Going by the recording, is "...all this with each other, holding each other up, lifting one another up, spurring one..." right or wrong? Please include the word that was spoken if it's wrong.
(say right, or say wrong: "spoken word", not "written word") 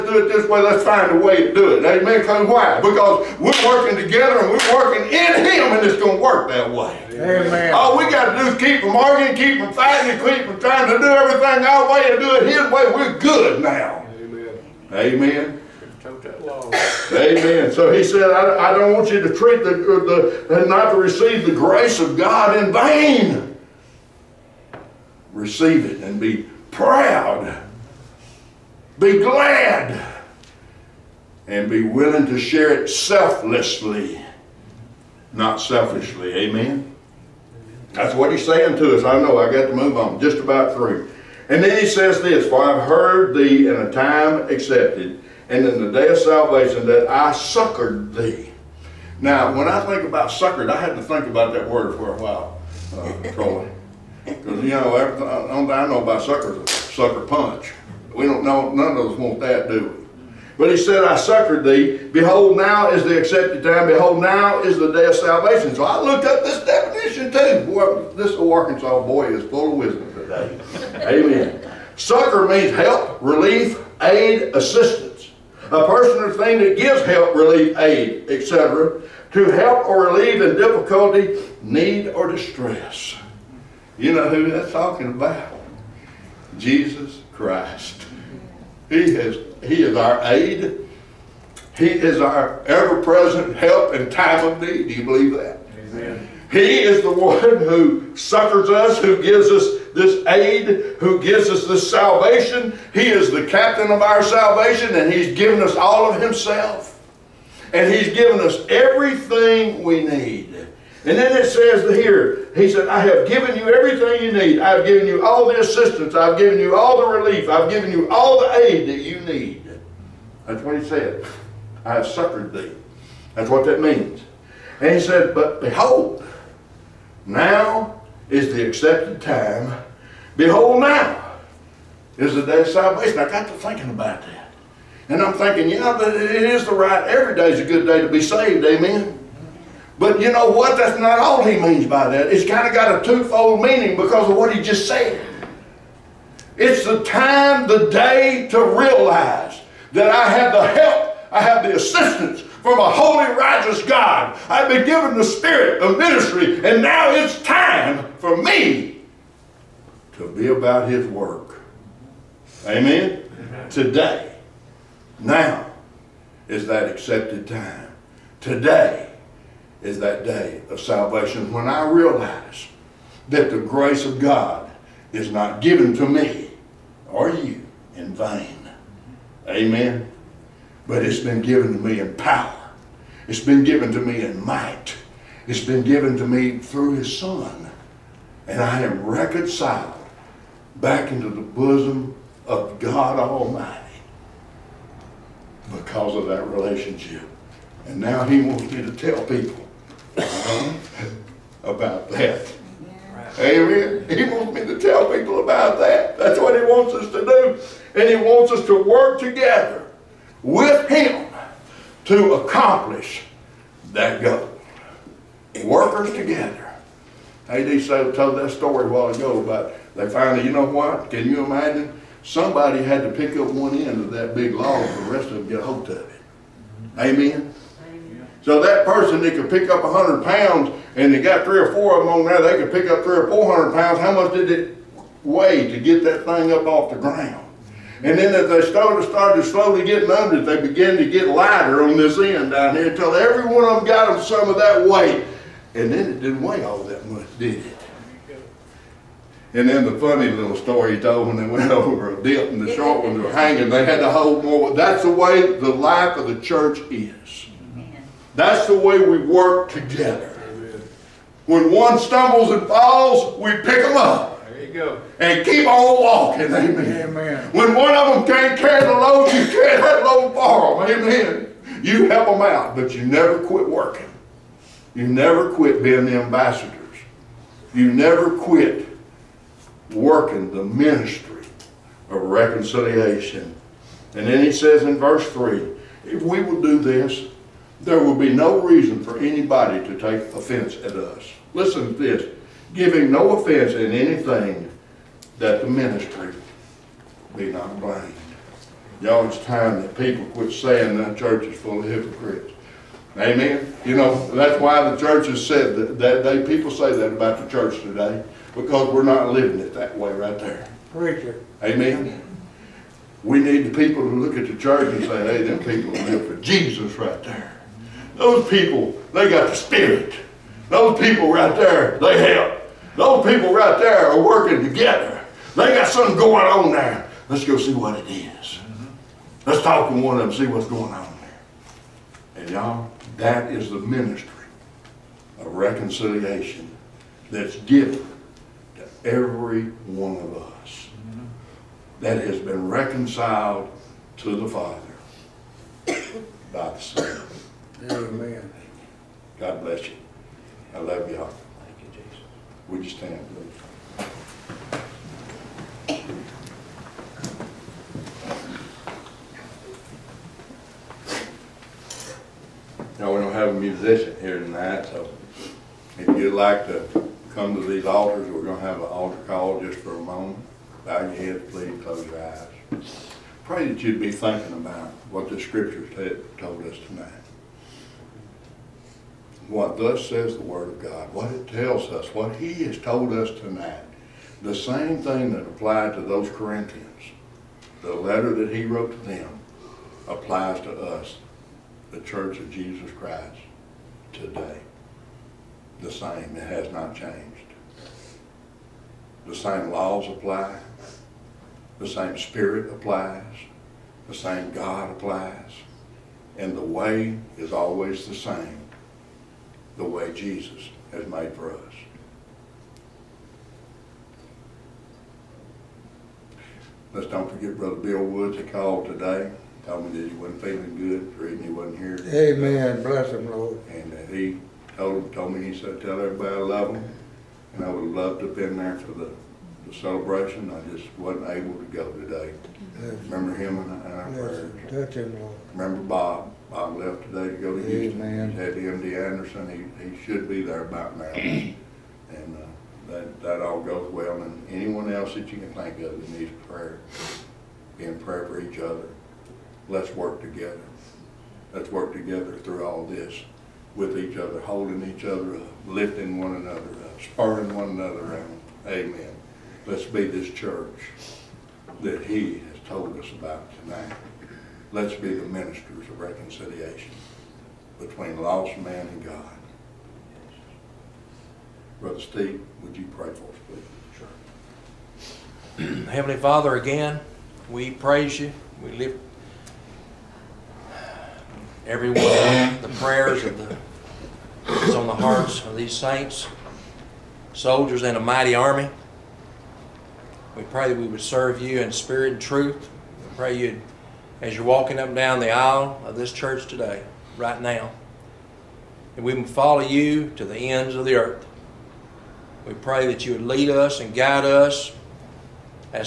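right.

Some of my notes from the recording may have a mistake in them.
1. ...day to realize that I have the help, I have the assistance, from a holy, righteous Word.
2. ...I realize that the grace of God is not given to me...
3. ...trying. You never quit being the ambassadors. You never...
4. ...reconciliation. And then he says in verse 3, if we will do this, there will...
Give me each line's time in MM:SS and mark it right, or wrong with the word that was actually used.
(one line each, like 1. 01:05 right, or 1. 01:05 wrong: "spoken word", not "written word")
1. 02:27 wrong: "God", not "Word"
2. 02:51 right
3. 04:33 wrong: "working", not "trying"
4. 04:42 right.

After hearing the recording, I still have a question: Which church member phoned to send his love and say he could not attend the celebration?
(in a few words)
Bill Woods.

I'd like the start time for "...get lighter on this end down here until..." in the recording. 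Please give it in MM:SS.
04:01.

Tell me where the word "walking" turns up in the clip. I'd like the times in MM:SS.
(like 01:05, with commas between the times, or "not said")
04:26, 08:14.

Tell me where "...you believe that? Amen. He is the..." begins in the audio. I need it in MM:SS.
01:34.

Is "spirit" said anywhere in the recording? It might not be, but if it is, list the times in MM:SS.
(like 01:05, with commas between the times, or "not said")
02:35, 05:19, 06:42, 08:11.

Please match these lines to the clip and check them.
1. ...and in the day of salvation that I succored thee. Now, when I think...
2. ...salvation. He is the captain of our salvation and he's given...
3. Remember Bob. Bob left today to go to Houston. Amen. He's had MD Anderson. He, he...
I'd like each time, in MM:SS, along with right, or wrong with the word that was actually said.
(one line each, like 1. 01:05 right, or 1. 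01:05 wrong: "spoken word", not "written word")
1. 00:45 right
2. 01:41 right
3. 07:15 right.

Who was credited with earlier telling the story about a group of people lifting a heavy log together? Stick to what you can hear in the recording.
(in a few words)
A.D. Sale.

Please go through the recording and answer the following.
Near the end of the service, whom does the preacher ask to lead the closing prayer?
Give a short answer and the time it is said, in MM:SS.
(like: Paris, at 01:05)
Brother Steve, at 07:51.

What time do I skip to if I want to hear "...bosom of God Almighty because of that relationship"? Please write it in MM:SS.
03:11.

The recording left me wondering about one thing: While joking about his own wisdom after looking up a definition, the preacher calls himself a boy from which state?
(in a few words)
Arkansas.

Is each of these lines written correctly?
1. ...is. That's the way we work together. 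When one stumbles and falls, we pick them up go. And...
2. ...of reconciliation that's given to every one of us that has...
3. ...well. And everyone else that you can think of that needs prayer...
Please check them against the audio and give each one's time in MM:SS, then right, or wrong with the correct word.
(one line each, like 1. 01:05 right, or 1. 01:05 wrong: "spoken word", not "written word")
1. 04:16 right
2. 05:35 right
3. 07:23 wrong: "anyone", not "everyone".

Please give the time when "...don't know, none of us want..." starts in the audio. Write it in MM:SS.
00:58.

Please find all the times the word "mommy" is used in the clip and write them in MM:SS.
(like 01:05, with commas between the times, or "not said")
not said.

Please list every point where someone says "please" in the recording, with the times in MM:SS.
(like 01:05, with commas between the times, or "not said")
05:53, 06:11, 07:53.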